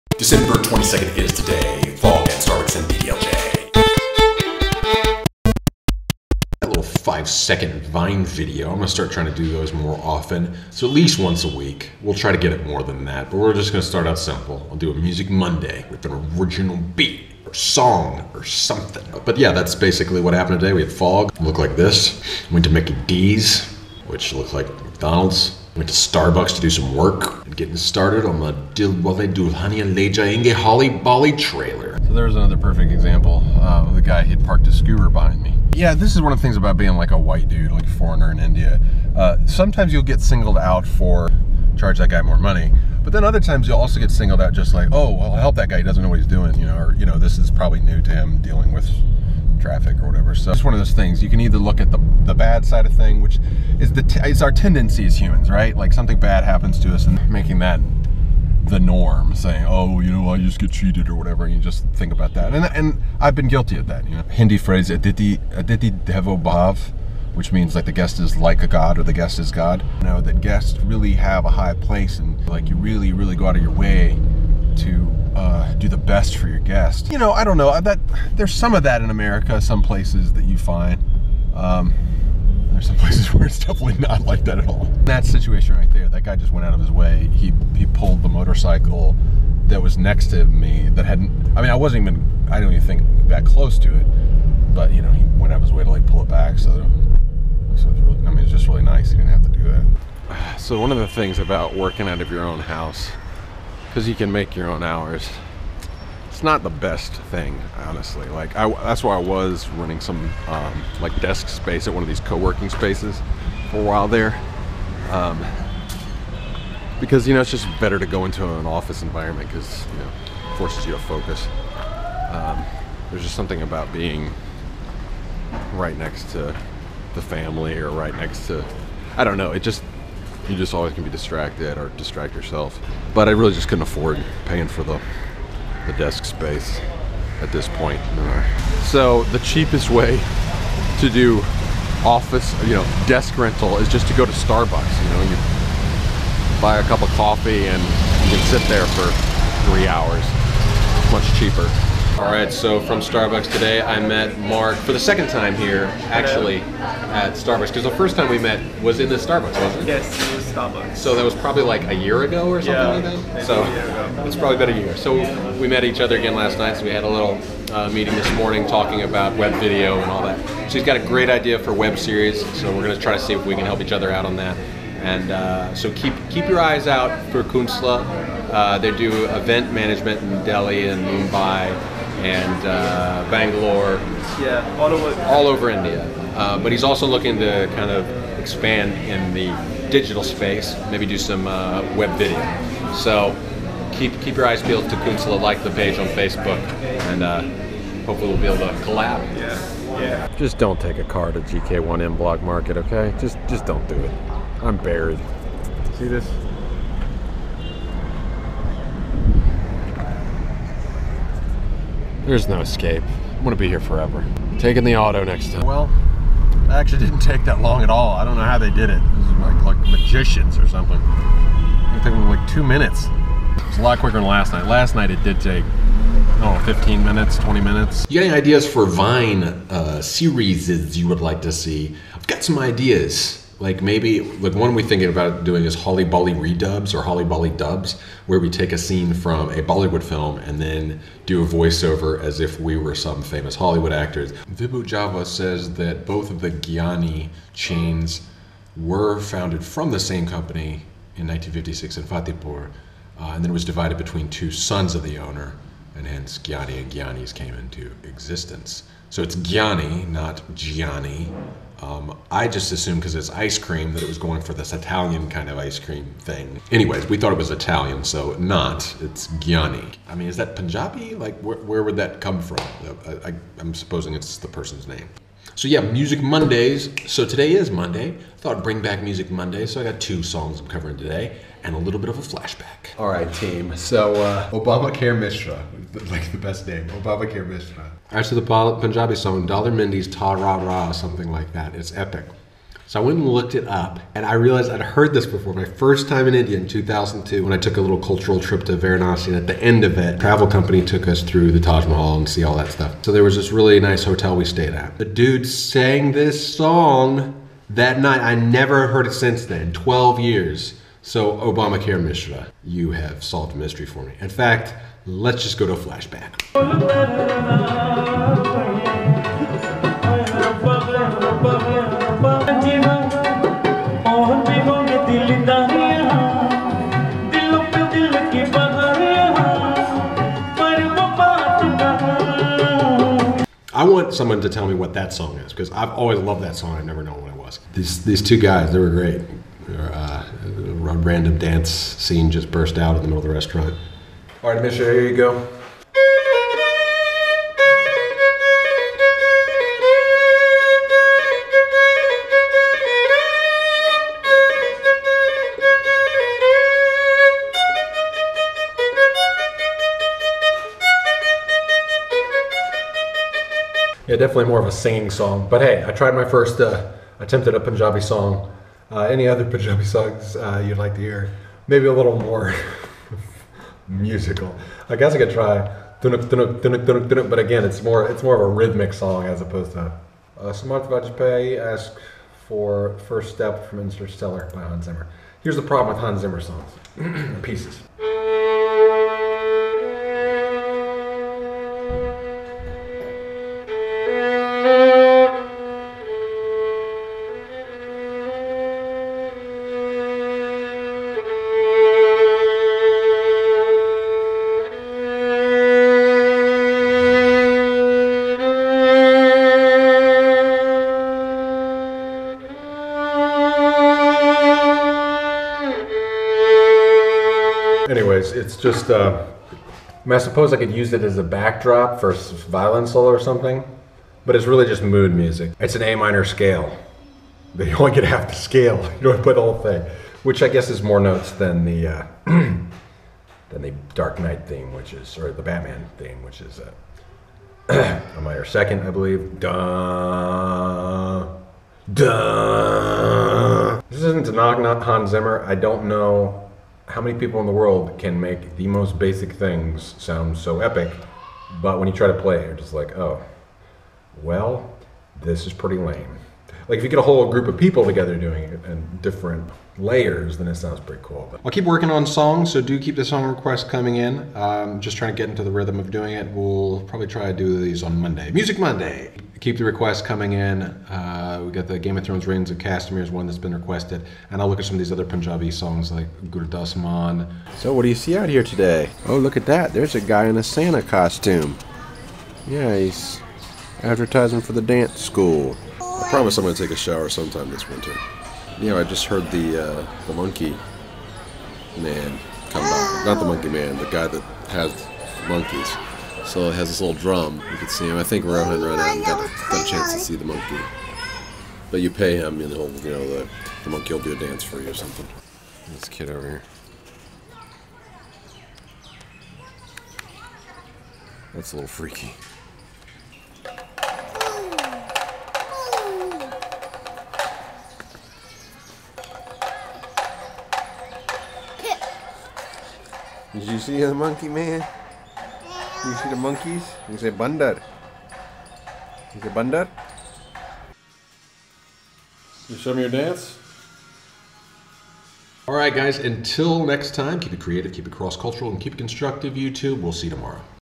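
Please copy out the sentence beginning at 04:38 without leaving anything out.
I thought I'd bring back Music Monday, so I got two songs I'm covering today and a little bit of a flashback.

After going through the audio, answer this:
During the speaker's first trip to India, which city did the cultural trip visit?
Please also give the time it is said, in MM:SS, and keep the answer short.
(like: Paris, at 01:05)
Varanasi, at 04:58.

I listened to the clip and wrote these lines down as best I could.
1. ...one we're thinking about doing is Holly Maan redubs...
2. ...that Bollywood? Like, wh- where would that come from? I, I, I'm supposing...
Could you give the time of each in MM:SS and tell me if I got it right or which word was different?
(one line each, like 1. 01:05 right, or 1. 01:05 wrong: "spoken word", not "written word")
1. 03:54 wrong: "Bolly", not "Maan"
2. 04:30 wrong: "Punjabi", not "Bollywood".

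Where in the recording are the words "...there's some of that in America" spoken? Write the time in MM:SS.
01:18.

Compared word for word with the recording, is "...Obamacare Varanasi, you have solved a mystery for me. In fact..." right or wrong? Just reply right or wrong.
wrong.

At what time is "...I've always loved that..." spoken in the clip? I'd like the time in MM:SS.
05:35.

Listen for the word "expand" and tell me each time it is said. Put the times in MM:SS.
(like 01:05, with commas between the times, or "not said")
03:08.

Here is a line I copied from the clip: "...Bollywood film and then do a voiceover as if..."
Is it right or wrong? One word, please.
right.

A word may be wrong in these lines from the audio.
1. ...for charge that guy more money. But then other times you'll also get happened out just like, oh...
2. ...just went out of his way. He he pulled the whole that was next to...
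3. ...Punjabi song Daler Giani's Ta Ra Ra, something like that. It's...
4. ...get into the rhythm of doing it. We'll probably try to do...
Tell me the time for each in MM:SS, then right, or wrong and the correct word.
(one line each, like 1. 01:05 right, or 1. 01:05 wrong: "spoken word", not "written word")
1. 00:40 wrong: "singled", not "happened"
2. 01:26 wrong: "motorcycle", not "whole"
3. 04:48 wrong: "Mehndi", not "Giani"
4. 07:45 right.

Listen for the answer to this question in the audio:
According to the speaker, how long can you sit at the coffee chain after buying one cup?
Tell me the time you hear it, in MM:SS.
02:29.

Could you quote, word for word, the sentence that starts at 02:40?
So that was probably like a year ago or something Yeah, like that?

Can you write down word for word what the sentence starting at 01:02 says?
And and I've been guilty of that.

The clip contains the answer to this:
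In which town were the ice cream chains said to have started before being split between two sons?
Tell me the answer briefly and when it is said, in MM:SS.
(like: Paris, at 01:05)
Fatehpur, at 04:12.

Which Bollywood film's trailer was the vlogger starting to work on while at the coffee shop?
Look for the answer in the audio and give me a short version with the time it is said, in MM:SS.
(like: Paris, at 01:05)
Dilwale Dulhania Le Jayenge, at 00:28.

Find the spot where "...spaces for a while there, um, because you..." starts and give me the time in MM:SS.
01:52.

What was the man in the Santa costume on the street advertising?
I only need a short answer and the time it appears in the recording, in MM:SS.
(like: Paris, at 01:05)
the dance school, at 08:04.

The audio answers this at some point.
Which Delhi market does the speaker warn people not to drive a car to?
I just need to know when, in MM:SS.
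03:21.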